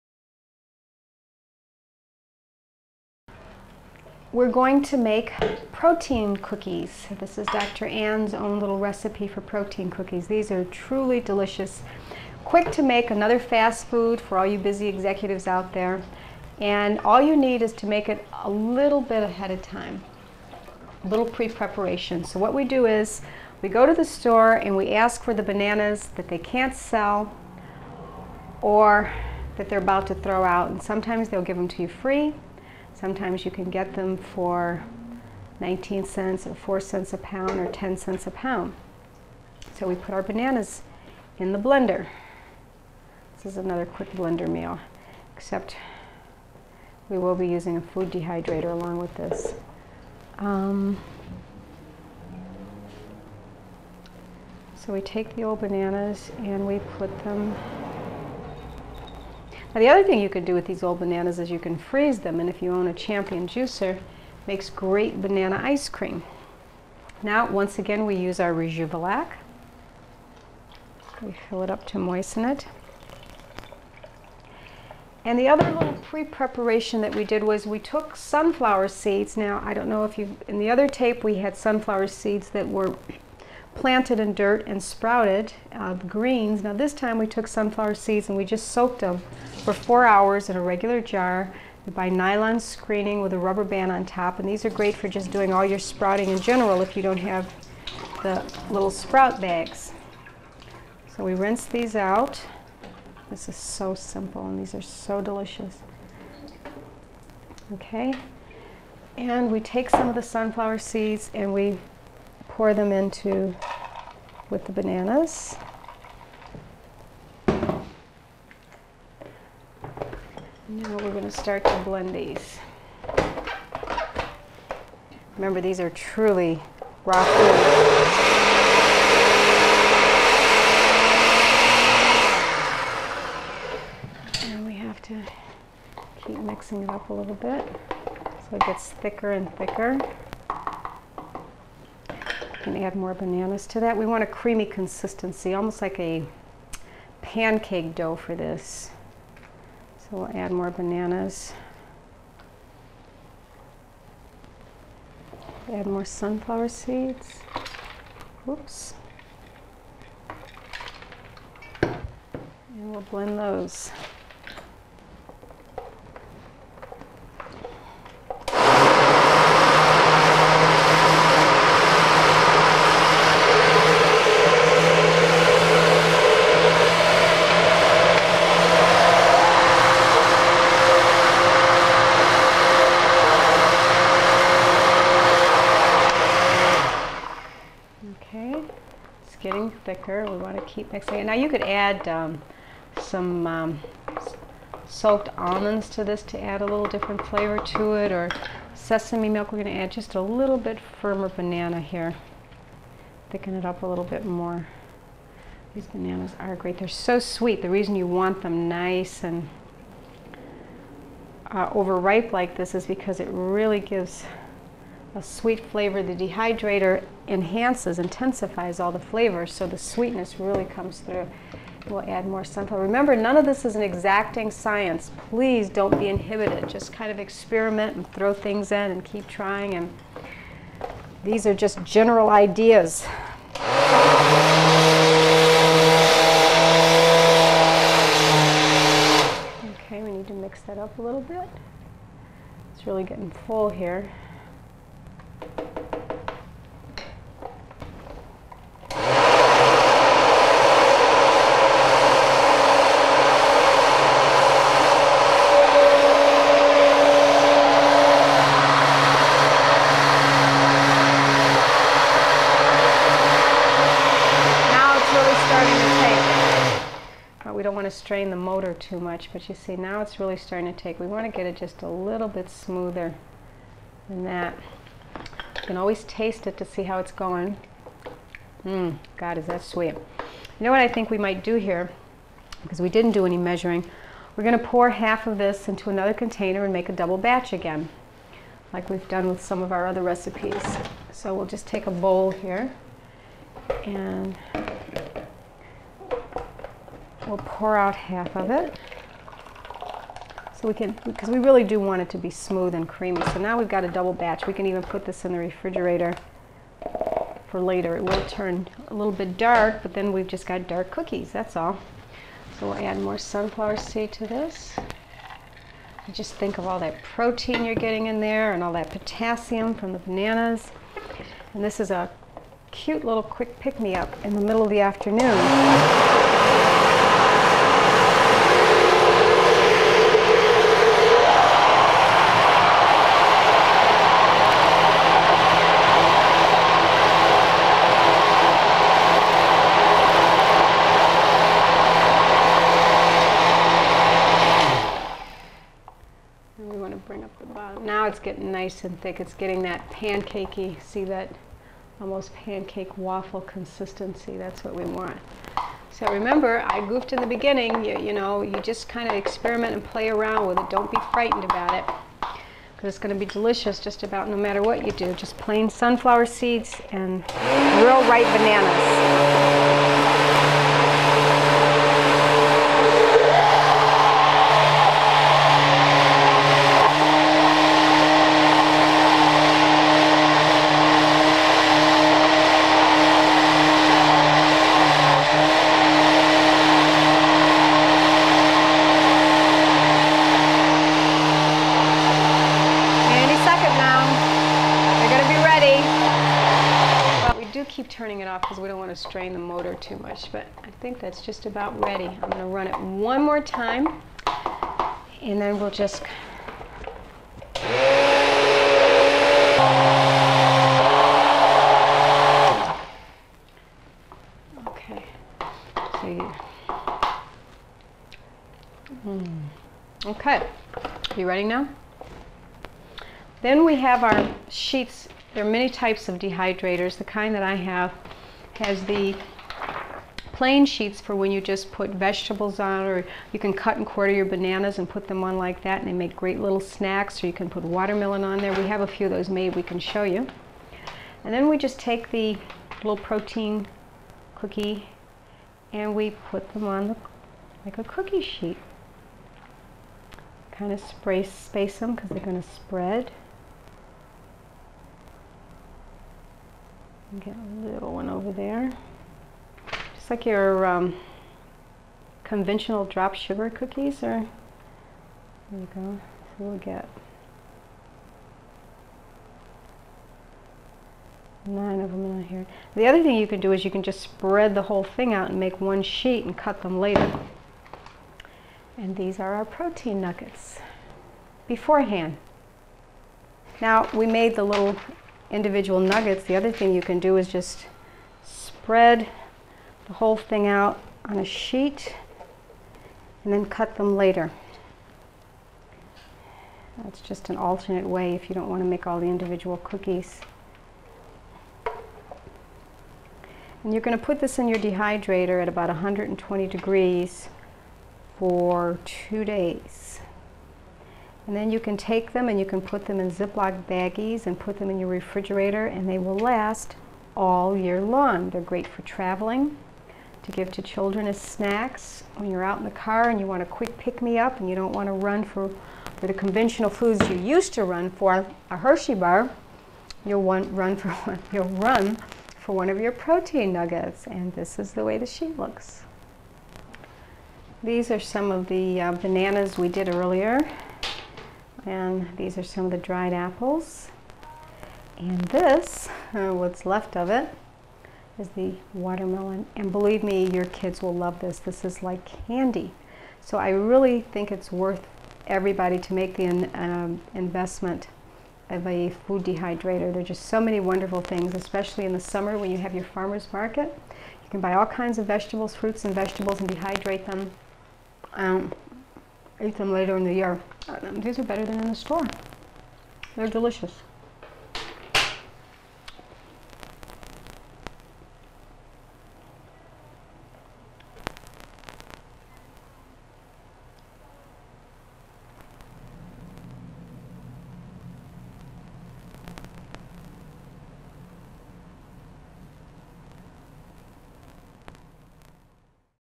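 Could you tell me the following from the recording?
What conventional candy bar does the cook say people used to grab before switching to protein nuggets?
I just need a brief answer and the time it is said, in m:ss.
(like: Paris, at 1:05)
Hershey bar, at 8:48.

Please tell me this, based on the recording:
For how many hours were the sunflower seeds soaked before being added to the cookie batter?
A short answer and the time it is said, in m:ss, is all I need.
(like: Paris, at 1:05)
4, at 1:29.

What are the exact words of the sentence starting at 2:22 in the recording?
And add more bananas to that.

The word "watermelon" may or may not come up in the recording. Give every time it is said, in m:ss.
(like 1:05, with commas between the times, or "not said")
7:17, 9:08.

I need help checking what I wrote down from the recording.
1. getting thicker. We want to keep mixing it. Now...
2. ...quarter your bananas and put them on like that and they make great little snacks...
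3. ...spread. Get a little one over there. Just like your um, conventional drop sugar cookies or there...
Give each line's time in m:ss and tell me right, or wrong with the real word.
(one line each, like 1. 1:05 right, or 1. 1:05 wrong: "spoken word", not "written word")
1. 3:09 right
2. 7:13 right
3. 7:32 right.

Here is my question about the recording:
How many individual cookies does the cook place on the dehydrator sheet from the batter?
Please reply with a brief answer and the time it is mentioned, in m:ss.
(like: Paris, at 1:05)
9, at 7:51.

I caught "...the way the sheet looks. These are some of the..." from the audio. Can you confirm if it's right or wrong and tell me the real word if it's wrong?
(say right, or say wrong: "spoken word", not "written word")
right.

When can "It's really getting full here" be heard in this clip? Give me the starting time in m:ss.
4:02.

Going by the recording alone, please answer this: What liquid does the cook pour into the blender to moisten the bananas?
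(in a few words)
Rejuvelac.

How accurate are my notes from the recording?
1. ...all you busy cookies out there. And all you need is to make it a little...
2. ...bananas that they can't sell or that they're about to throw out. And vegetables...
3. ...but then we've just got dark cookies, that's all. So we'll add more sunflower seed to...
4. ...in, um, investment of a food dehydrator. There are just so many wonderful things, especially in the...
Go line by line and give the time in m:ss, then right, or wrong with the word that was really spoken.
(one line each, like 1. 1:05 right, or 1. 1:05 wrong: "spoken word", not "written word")
1. 0:14 wrong: "executives", not "cookies"
2. 0:25 wrong: "sometimes", not "vegetables"
3. 5:09 right
4. 9:16 right.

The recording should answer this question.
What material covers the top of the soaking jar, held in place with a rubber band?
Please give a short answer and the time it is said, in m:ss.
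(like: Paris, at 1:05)
Nylon screening, at 1:32.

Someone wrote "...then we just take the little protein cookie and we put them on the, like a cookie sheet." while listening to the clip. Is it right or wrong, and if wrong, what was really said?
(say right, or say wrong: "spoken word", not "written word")
right.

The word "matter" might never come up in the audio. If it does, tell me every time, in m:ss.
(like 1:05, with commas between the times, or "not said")
6:04.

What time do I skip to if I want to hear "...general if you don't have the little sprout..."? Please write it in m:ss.
1:36.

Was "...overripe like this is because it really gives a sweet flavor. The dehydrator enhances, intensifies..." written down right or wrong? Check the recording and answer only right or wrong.
right.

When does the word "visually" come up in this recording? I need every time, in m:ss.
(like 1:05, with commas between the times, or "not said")
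not said.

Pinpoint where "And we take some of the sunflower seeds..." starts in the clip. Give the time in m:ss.
1:49.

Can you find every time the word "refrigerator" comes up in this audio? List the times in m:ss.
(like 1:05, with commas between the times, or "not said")
5:05, 8:34.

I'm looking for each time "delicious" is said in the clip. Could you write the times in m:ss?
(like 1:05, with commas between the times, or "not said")
0:11, 1:45, 6:03, 9:33.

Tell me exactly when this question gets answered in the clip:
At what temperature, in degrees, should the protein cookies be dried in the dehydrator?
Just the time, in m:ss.
8:25.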